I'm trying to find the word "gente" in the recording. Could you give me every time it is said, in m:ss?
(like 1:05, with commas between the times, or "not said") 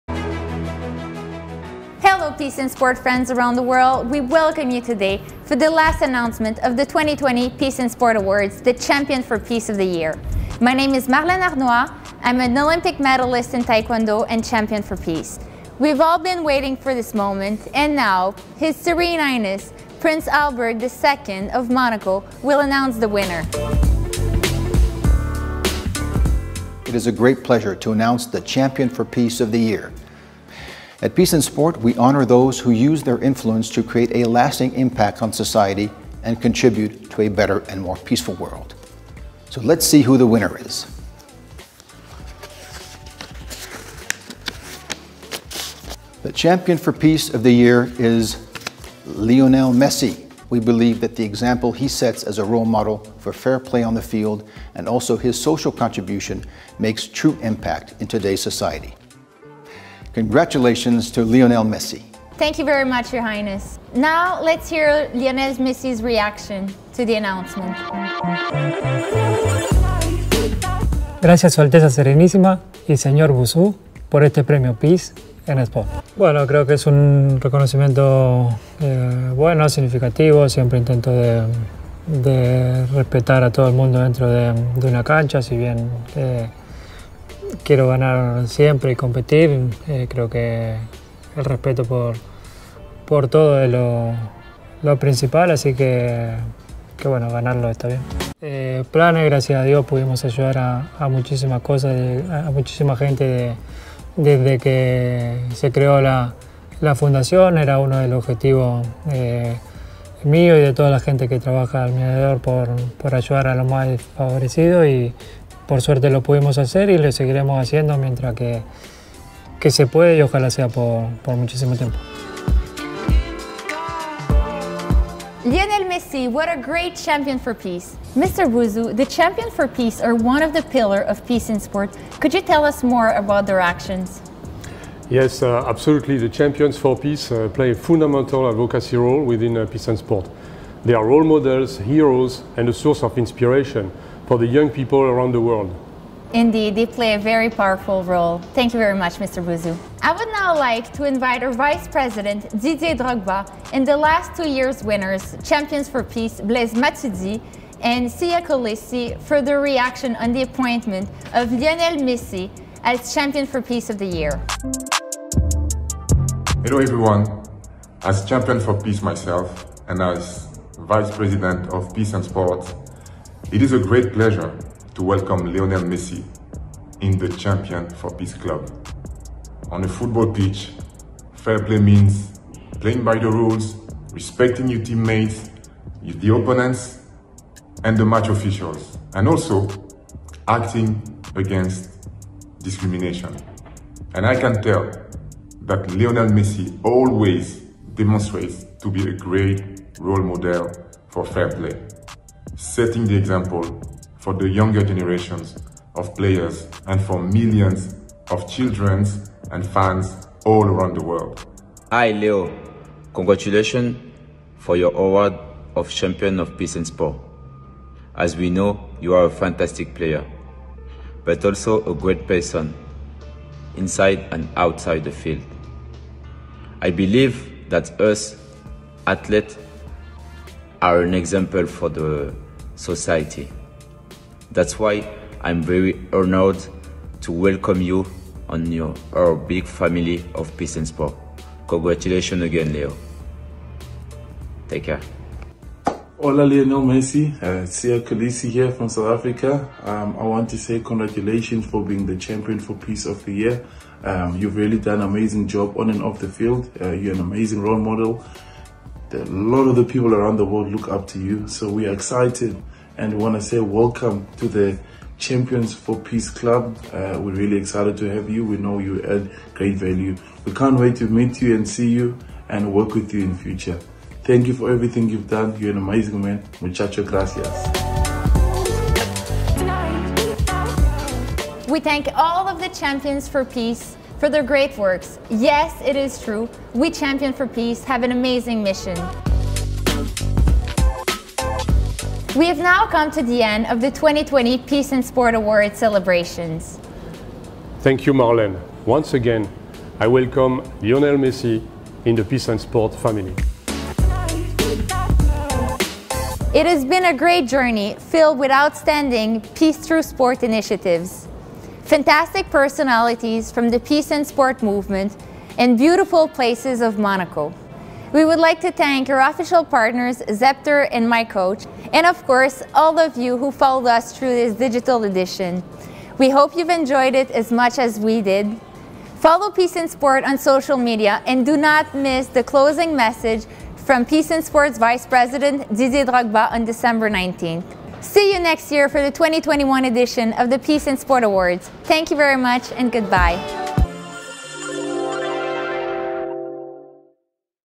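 1:42, 1:50.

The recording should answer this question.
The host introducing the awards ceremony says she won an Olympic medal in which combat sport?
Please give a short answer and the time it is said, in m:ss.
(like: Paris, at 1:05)
Taekwondo, at 0:13.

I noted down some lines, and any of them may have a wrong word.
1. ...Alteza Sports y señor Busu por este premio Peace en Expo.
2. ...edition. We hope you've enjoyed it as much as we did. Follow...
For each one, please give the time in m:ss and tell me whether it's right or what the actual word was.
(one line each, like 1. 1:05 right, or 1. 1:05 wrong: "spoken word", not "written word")
1. 1:11 wrong: "Serenísima", not "Sports"
2. 5:25 right.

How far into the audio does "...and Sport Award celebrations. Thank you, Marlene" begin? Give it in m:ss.
4:54.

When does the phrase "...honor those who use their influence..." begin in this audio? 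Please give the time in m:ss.
0:31.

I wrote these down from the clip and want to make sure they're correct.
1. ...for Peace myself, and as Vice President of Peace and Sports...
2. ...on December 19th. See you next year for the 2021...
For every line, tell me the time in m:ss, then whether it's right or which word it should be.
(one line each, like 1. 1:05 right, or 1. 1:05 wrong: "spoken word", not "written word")
1. 2:48 right
2. 5:36 right.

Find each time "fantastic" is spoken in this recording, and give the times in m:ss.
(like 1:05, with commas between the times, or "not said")
3:39, 5:11.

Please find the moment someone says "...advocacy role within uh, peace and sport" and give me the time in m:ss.
2:18.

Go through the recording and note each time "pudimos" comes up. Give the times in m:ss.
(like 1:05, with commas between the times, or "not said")
1:39, 1:56.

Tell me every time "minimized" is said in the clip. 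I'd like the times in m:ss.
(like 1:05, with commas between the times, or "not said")
not said.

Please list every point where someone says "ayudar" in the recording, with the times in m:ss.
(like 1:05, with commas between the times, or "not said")
1:40, 1:53.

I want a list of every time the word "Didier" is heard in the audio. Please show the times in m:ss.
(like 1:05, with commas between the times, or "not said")
2:32, 5:35.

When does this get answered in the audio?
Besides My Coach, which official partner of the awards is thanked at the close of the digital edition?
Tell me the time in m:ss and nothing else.
5:20.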